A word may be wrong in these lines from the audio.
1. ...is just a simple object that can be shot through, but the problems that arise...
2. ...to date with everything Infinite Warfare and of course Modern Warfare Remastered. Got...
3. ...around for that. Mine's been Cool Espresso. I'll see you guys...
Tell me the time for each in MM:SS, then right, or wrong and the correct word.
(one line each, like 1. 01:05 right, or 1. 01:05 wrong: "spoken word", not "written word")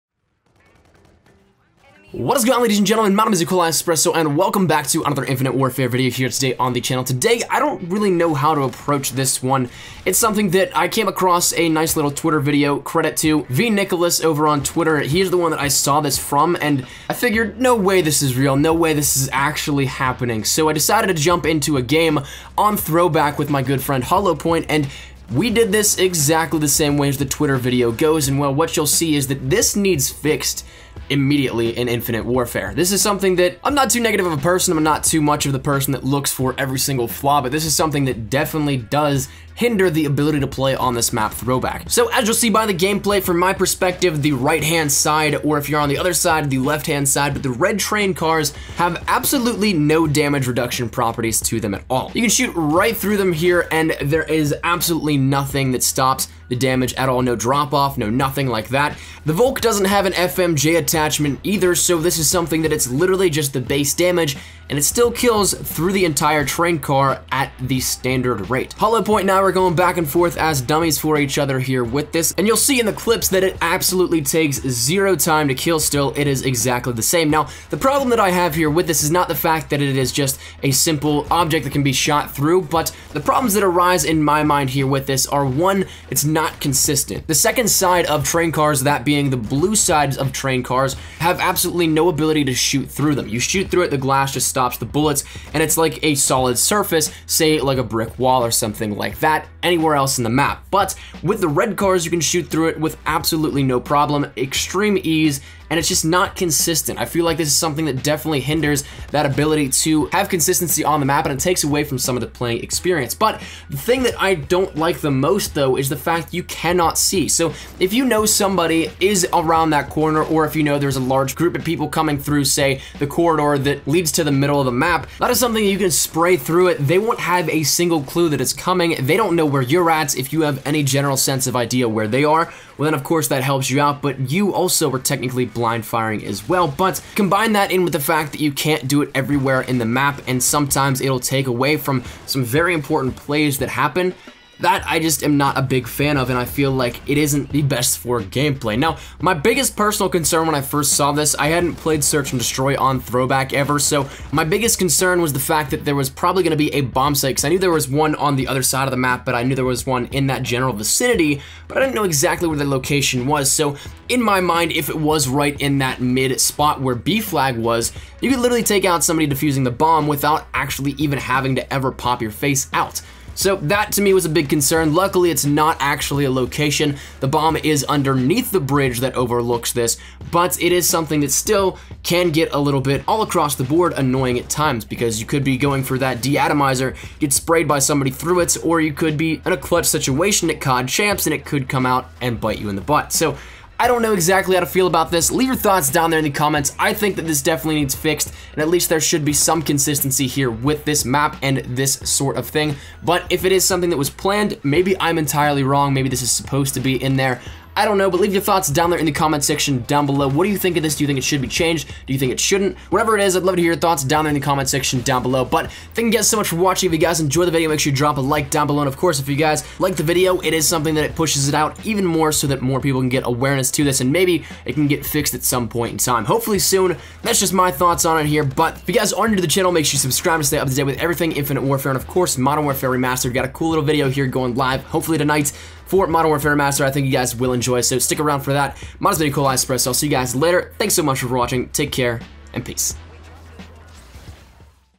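1. 01:19 right
2. 03:50 right
3. 03:58 right.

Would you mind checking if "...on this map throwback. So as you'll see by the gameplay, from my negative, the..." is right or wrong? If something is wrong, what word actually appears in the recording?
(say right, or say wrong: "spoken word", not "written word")
wrong: "perspective", not "negative".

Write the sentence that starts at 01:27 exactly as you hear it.
The second side of train cars, that being the blue sides of train cars, have absolutely no ability to shoot through them.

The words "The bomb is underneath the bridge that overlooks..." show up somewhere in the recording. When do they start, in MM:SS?
02:57.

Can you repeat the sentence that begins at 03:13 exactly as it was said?
So I don't know exactly how to feel about this.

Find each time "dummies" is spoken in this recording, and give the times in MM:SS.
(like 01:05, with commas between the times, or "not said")
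01:10.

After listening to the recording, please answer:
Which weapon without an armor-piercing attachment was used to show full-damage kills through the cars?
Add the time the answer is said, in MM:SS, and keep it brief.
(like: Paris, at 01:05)
Volk, at 00:59.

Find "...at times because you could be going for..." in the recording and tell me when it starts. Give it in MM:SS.
03:04.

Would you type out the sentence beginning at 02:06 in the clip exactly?
They won't have a single clue that it's coming.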